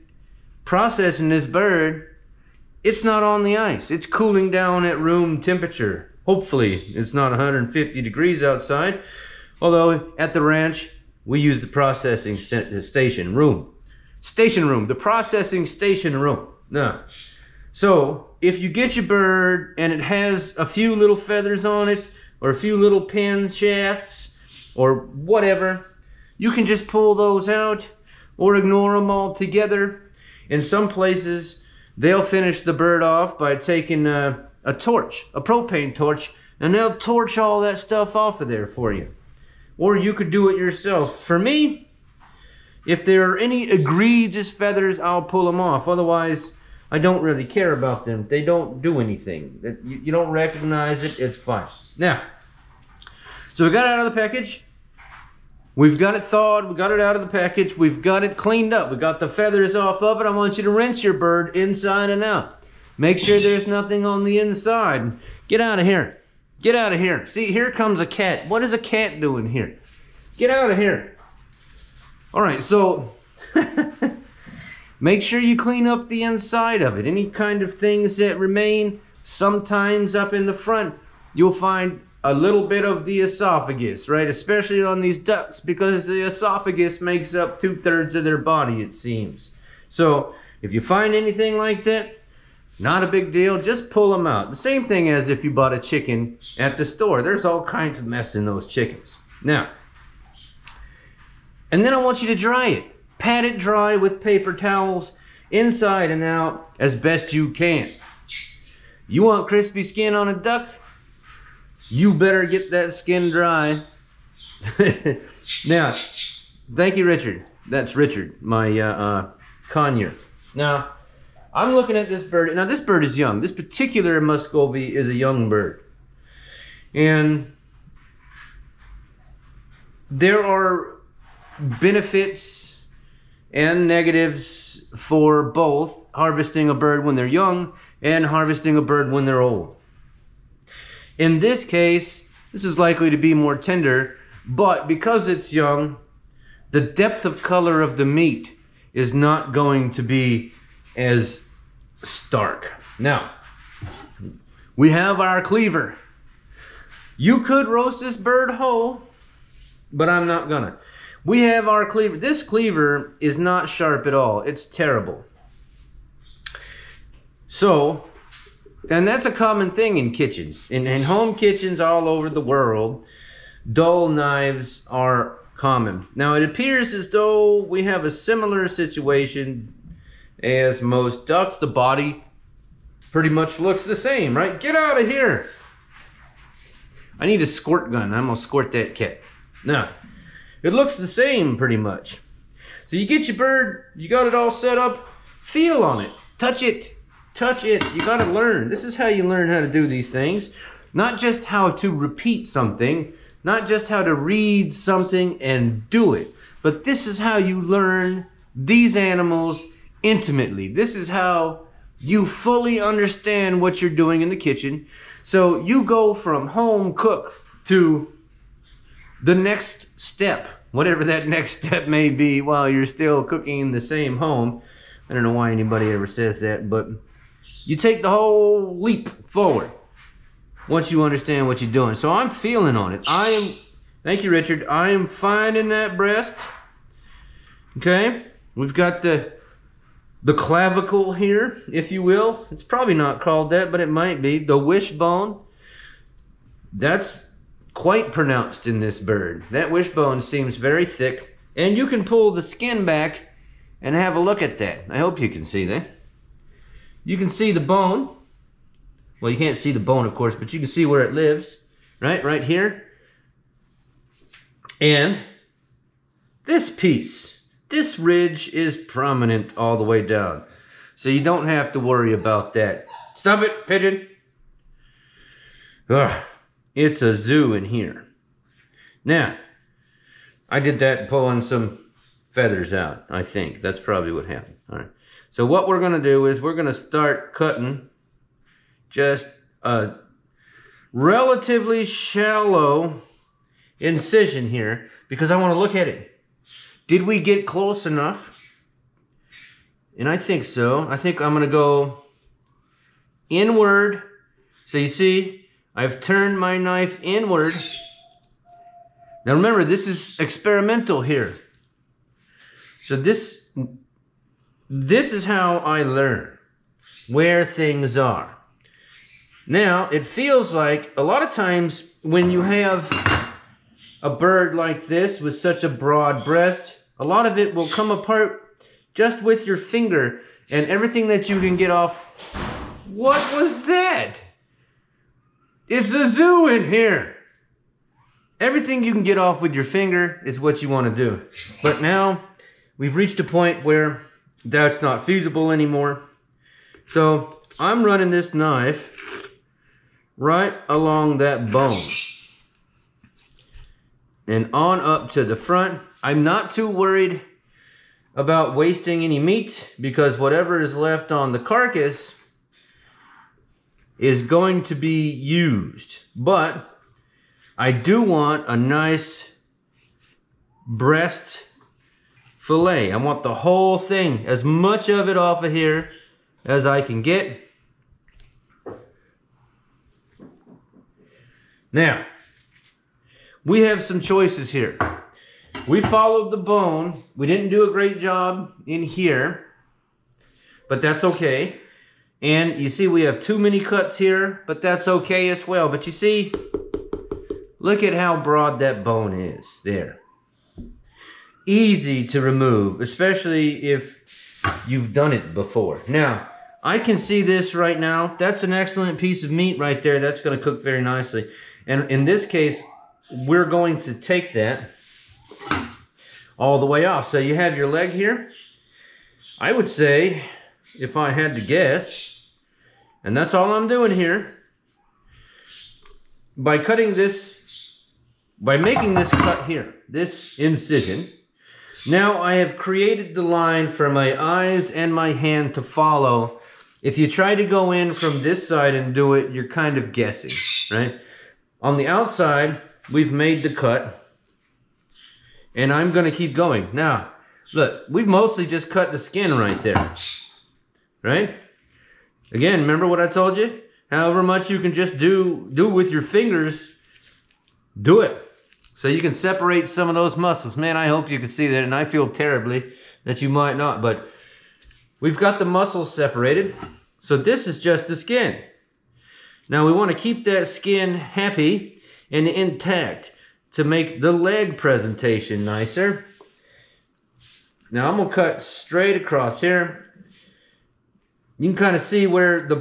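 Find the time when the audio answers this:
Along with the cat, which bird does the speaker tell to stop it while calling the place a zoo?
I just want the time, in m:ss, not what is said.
4:33.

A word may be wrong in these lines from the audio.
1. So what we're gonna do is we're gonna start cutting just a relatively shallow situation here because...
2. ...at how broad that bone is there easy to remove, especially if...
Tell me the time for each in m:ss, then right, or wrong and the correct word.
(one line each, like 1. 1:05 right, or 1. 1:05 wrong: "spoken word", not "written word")
1. 4:45 wrong: "incision", not "situation"
2. 6:37 right.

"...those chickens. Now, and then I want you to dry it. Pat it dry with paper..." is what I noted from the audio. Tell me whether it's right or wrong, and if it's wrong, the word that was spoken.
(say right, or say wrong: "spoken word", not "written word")
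right.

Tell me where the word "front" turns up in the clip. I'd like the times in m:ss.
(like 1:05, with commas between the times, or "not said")
1:20, 5:55.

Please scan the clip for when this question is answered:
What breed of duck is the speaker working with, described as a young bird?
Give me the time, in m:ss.
2:04.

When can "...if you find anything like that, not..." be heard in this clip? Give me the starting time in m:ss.
1:30.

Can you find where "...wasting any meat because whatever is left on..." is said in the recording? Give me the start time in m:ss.
5:58.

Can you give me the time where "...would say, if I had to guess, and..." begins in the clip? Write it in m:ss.
6:59.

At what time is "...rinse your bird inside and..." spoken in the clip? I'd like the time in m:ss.
1:00.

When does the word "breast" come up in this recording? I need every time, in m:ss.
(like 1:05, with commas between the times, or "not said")
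3:55, 5:26, 6:10.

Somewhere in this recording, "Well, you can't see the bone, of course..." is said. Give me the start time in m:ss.
4:19.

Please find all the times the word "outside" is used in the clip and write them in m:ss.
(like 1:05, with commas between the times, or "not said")
0:08, 7:21.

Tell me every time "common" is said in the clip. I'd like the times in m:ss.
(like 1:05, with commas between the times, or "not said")
2:49, 2:55.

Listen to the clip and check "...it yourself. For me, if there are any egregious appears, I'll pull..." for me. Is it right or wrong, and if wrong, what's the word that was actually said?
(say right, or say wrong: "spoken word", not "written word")
wrong: "feathers", not "appears".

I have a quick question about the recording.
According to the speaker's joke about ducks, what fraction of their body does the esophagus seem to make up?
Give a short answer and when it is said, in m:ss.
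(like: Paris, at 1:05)
two thirds, at 1:27.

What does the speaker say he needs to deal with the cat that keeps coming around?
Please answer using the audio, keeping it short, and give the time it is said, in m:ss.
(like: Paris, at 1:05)
a squirt gun, at 3:07.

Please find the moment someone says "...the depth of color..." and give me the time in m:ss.
2:26.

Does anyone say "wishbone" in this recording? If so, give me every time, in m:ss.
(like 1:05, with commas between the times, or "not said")
4:04, 4:09.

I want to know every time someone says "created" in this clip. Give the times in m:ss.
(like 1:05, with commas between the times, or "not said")
7:12.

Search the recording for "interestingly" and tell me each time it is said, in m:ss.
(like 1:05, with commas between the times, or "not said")
not said.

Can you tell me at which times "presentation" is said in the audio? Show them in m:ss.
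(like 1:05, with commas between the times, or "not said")
7:54.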